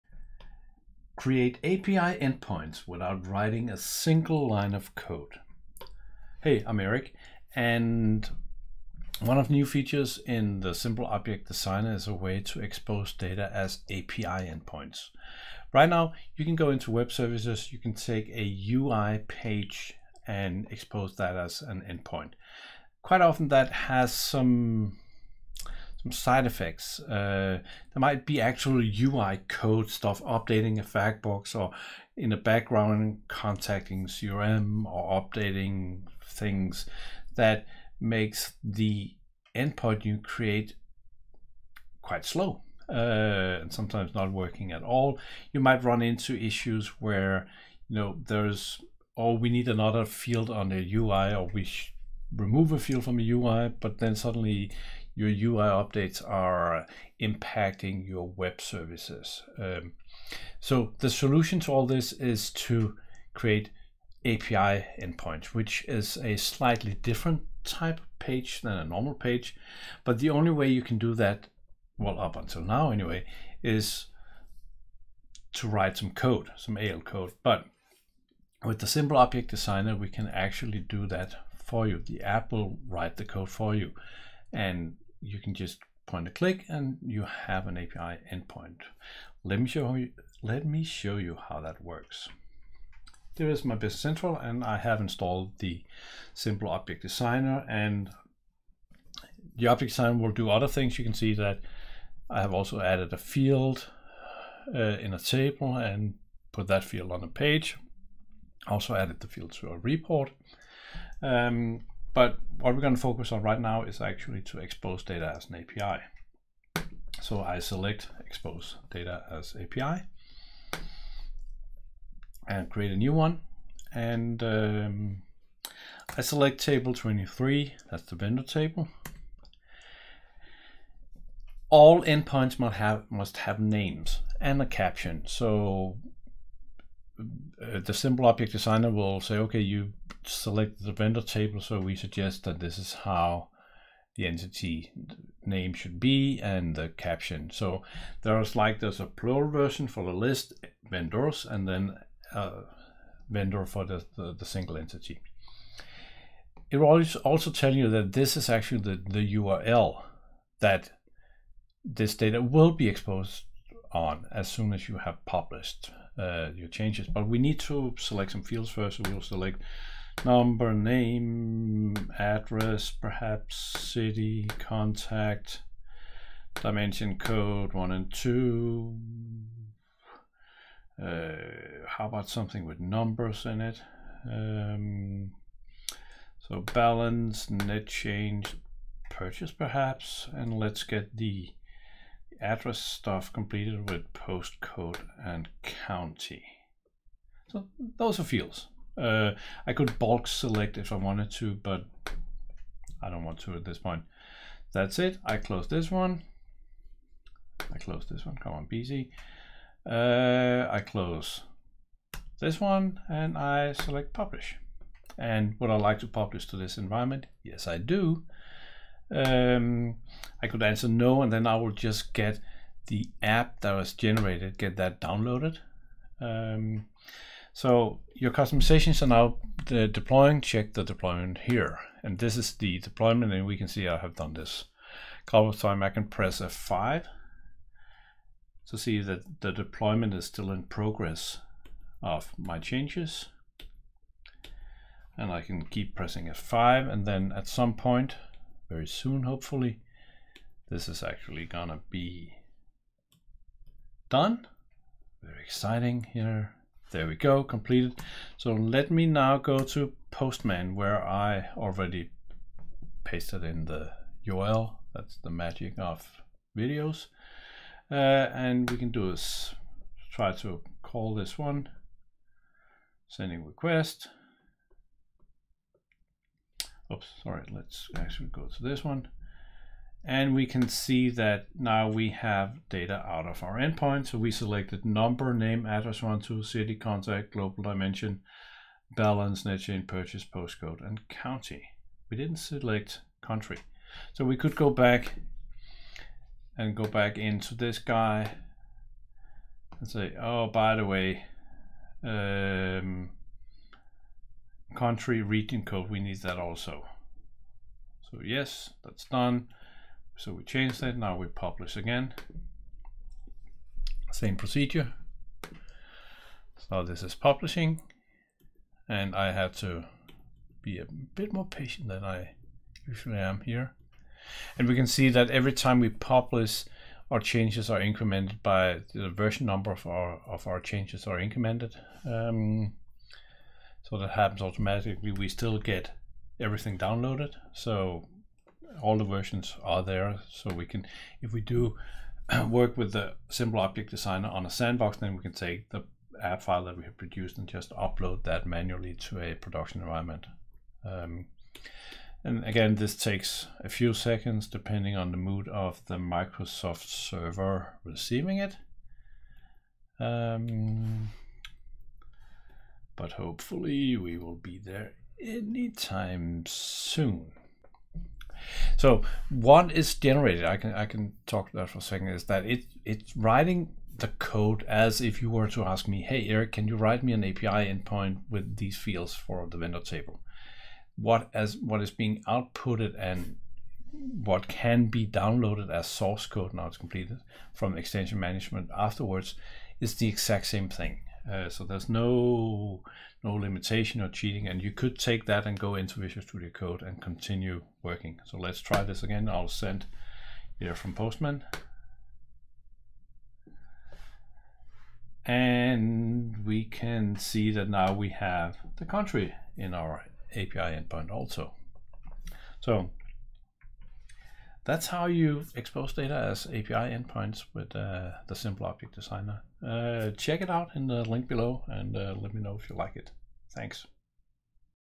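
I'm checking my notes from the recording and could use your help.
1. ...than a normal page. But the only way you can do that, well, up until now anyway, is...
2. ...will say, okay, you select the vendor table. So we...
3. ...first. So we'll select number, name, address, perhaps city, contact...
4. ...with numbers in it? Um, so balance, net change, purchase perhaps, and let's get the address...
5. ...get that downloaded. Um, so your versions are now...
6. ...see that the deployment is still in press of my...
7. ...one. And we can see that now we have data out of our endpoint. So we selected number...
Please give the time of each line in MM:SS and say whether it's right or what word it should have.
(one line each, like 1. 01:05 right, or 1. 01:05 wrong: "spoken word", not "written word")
1. 01:08 right
2. 02:18 right
3. 02:48 right
4. 03:02 right
5. 03:44 wrong: "customizations", not "versions"
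6. 03:58 wrong: "progress", not "press"
7. 04:38 right.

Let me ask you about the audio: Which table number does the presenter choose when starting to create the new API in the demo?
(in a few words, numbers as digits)
23.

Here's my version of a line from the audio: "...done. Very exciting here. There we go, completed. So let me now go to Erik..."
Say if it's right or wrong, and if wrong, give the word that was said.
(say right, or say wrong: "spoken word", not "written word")
wrong: "Postman", not "Erik".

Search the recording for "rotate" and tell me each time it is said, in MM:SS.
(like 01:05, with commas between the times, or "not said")
not said.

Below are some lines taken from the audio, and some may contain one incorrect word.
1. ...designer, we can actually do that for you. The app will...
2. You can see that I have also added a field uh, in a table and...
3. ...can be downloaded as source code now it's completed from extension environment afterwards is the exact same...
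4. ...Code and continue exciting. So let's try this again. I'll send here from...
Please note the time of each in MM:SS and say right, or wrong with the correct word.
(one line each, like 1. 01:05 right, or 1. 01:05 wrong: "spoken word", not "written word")
1. 01:19 right
2. 01:40 right
3. 06:24 wrong: "management", not "environment"
4. 06:36 wrong: "working", not "exciting".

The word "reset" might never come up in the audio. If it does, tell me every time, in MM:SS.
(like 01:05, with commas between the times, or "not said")
not said.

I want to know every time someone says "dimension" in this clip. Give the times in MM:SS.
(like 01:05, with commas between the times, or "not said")
02:56, 04:47.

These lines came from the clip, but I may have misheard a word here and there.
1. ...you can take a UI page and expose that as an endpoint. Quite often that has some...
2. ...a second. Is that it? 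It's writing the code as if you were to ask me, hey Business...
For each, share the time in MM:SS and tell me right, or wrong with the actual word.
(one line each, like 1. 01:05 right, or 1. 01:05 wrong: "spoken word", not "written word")
1. 00:17 right
2. 06:11 wrong: "Erik", not "Business".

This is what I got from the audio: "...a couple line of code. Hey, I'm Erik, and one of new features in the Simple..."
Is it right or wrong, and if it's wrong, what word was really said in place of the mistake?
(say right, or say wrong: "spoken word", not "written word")
wrong: "single", not "couple".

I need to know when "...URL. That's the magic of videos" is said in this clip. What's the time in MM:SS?
04:24.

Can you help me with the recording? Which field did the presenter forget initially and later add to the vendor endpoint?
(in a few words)
country region code.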